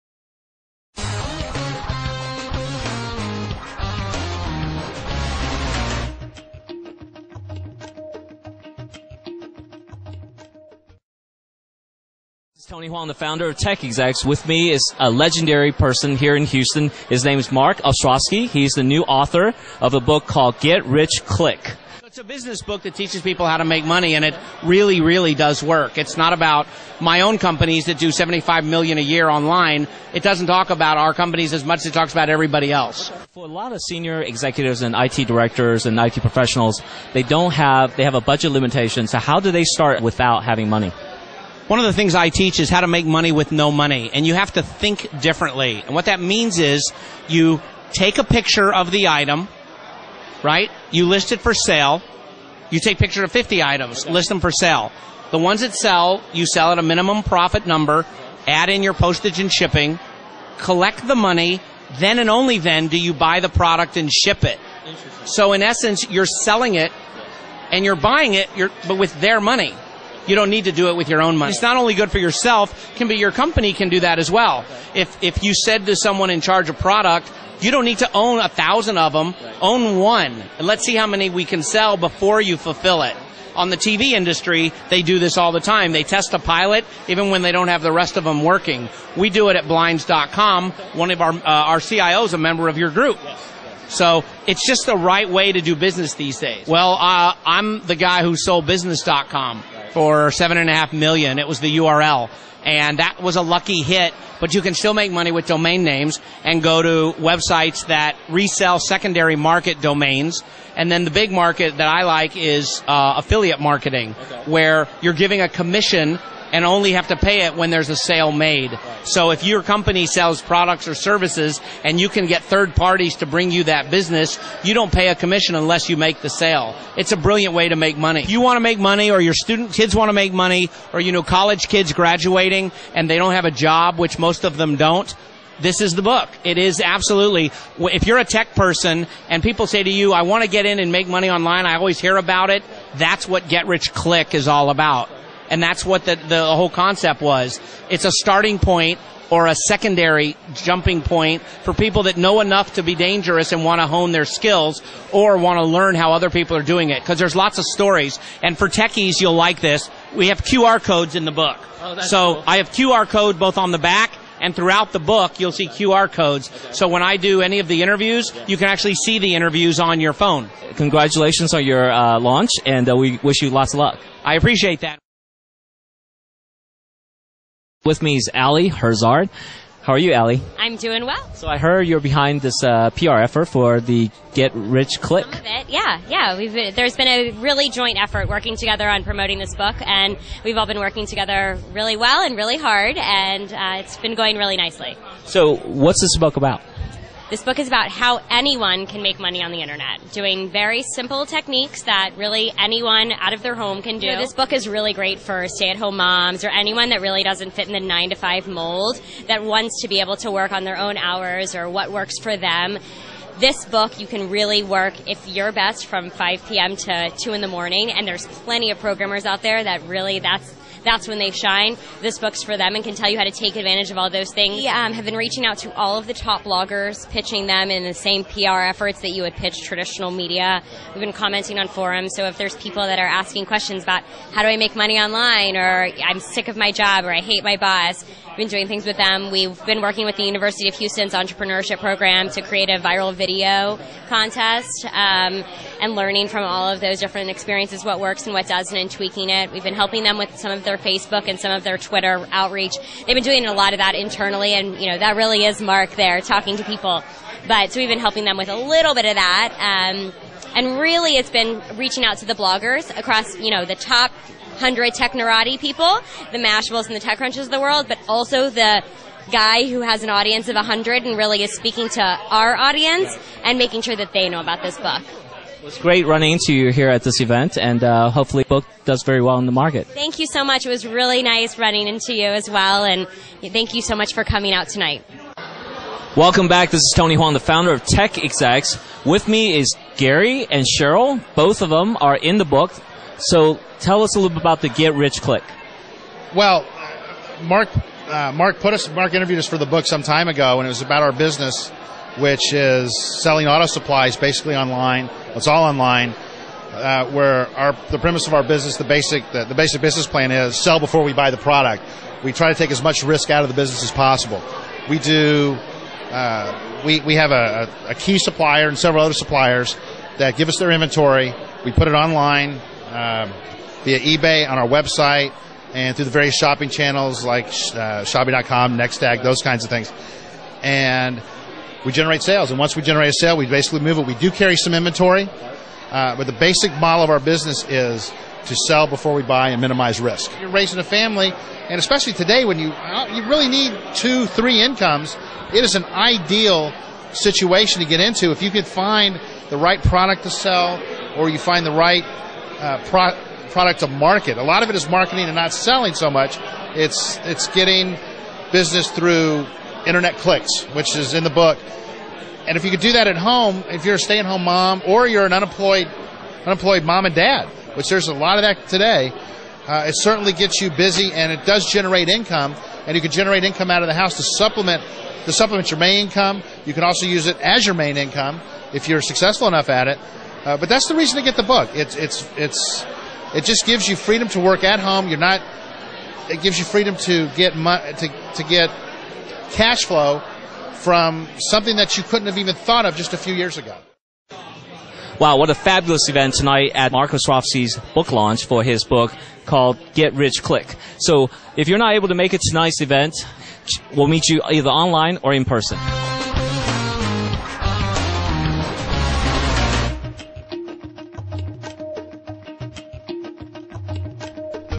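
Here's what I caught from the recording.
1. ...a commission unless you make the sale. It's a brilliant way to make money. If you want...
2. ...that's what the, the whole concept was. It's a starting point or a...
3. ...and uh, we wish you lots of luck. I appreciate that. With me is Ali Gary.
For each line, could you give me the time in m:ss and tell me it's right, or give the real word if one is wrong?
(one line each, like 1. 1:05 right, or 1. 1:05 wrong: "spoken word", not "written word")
1. 2:05 right
2. 2:25 right
3. 2:52 wrong: "Herzard", not "Gary".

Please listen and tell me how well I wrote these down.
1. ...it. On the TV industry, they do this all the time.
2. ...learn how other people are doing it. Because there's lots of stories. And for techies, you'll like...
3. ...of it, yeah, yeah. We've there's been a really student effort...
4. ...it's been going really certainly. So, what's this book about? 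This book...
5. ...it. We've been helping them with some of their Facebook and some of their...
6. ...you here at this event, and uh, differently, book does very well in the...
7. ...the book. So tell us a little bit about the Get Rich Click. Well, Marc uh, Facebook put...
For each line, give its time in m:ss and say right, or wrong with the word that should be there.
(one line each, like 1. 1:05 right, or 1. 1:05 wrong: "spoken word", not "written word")
1. 1:23 right
2. 2:35 right
3. 3:05 wrong: "joint", not "student"
4. 3:13 wrong: "nicely", not "certainly"
5. 4:09 right
6. 4:36 wrong: "hopefully", not "differently"
7. 4:52 wrong: "Marc", not "Facebook".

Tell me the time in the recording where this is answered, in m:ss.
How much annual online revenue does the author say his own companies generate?
0:28.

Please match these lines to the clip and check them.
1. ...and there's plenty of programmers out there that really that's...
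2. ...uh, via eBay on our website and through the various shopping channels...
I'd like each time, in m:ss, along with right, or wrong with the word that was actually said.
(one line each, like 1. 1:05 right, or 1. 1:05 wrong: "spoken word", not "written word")
1. 3:37 right
2. 5:22 right.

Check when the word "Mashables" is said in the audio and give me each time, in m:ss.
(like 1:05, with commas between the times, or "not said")
4:26.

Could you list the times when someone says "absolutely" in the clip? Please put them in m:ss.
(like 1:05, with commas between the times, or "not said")
2:16.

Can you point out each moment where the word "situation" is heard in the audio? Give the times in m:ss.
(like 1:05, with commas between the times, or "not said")
5:47.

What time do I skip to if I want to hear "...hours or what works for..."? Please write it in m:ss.
3:30.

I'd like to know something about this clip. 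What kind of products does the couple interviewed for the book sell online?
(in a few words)
Auto supplies.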